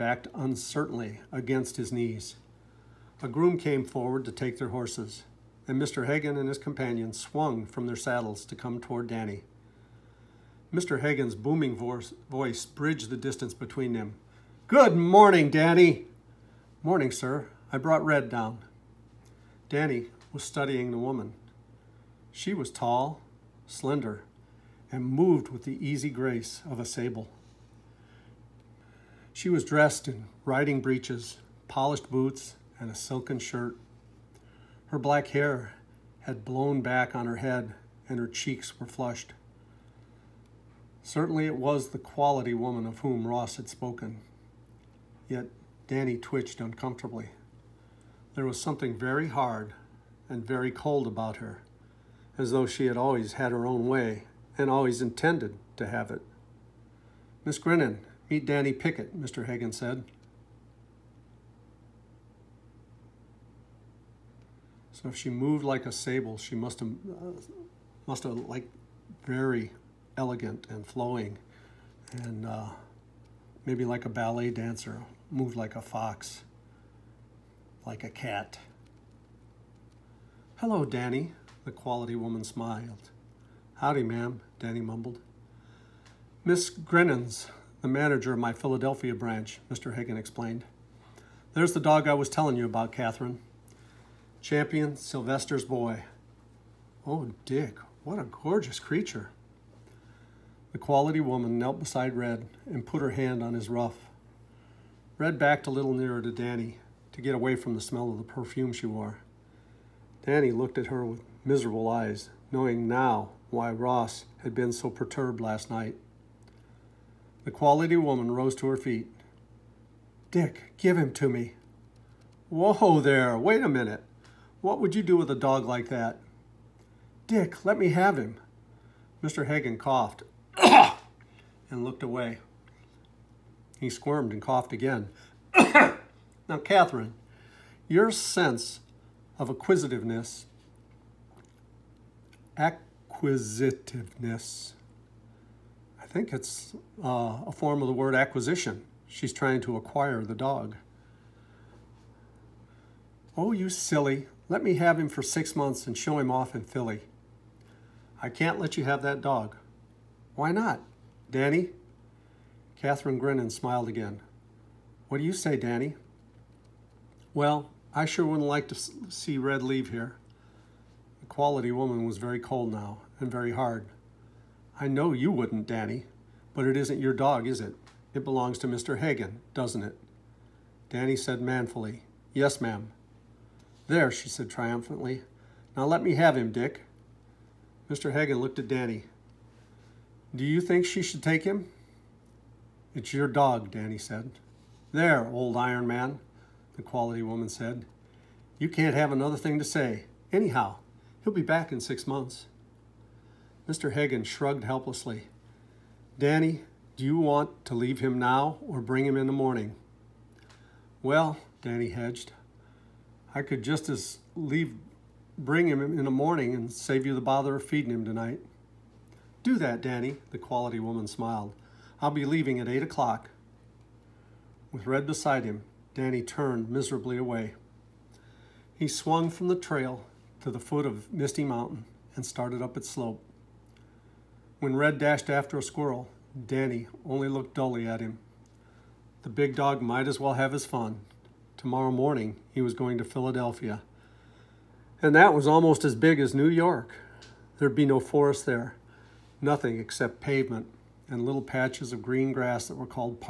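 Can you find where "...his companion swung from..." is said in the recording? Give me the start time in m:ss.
0:06.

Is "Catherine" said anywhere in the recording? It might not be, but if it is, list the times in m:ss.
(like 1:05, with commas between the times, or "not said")
1:32, 2:16, 2:42.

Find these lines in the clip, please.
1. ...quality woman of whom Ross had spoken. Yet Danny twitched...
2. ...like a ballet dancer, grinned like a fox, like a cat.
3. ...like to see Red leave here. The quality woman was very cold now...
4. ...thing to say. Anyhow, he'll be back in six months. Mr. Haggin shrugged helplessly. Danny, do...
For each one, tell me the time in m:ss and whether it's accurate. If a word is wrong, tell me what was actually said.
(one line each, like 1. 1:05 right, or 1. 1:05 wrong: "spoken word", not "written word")
1. 0:41 right
2. 1:13 wrong: "moved", not "grinned"
3. 2:48 right
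4. 3:19 right.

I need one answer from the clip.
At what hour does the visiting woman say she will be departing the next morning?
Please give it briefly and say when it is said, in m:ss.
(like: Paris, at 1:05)
8 o'clock, at 3:42.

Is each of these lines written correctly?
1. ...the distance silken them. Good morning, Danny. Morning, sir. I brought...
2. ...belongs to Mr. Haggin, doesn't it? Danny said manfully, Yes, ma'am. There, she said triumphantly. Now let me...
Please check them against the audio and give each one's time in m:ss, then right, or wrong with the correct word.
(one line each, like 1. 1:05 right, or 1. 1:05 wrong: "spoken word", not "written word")
1. 0:13 wrong: "between", not "silken"
2. 2:58 right.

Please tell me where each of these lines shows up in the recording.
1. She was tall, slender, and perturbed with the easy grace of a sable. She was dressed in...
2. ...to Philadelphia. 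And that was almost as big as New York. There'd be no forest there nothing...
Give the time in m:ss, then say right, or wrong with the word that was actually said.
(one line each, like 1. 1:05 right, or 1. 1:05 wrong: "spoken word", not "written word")
1. 0:22 wrong: "moved", not "perturbed"
2. 4:02 right.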